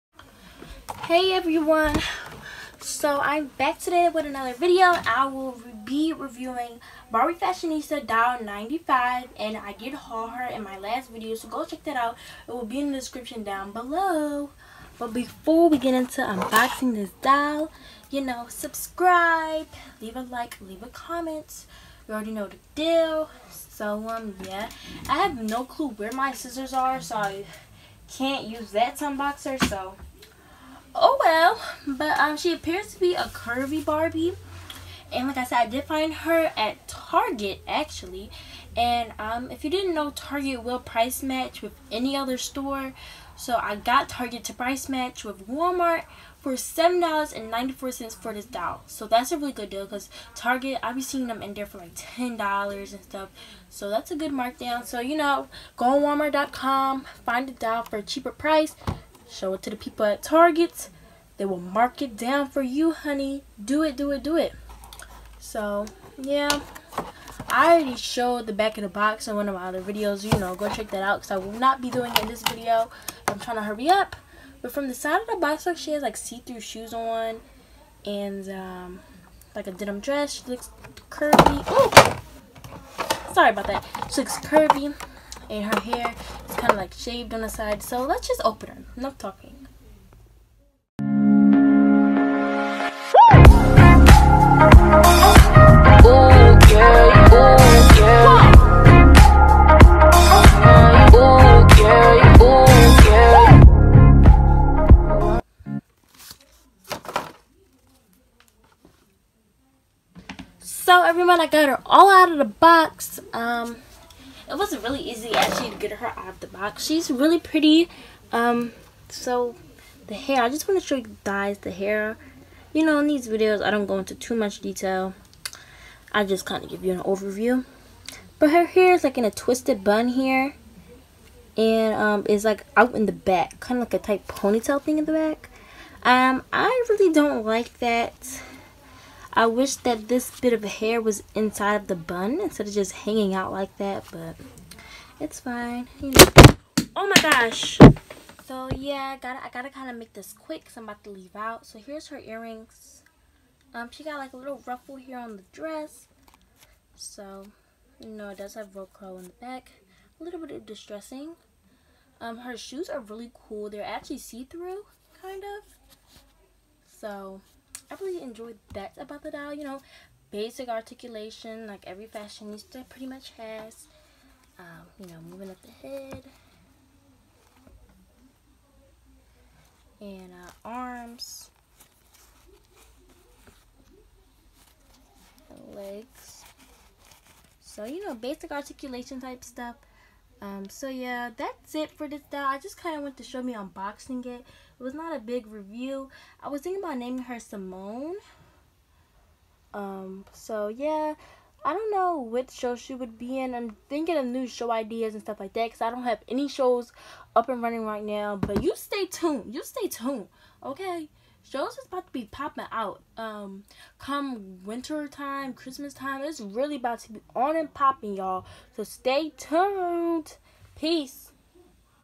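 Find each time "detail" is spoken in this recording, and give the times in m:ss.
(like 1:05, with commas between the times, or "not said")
2:04.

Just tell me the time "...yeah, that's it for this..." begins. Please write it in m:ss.
3:10.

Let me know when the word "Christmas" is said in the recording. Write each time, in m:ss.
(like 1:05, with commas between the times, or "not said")
3:35.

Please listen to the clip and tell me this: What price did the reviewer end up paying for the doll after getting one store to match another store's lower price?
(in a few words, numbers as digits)
$7.94.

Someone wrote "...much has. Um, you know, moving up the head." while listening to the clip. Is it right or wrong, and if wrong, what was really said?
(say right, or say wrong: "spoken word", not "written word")
right.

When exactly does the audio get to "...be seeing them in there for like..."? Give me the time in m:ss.
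0:50.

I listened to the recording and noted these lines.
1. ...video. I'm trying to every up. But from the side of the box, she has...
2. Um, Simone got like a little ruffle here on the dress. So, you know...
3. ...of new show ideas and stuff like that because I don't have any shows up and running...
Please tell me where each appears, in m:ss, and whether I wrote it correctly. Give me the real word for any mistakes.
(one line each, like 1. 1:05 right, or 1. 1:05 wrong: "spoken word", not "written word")
1. 1:12 wrong: "hurry", not "every"
2. 2:33 wrong: "She", not "Simone"
3. 3:24 right.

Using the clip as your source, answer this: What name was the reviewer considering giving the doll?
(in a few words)
Simone.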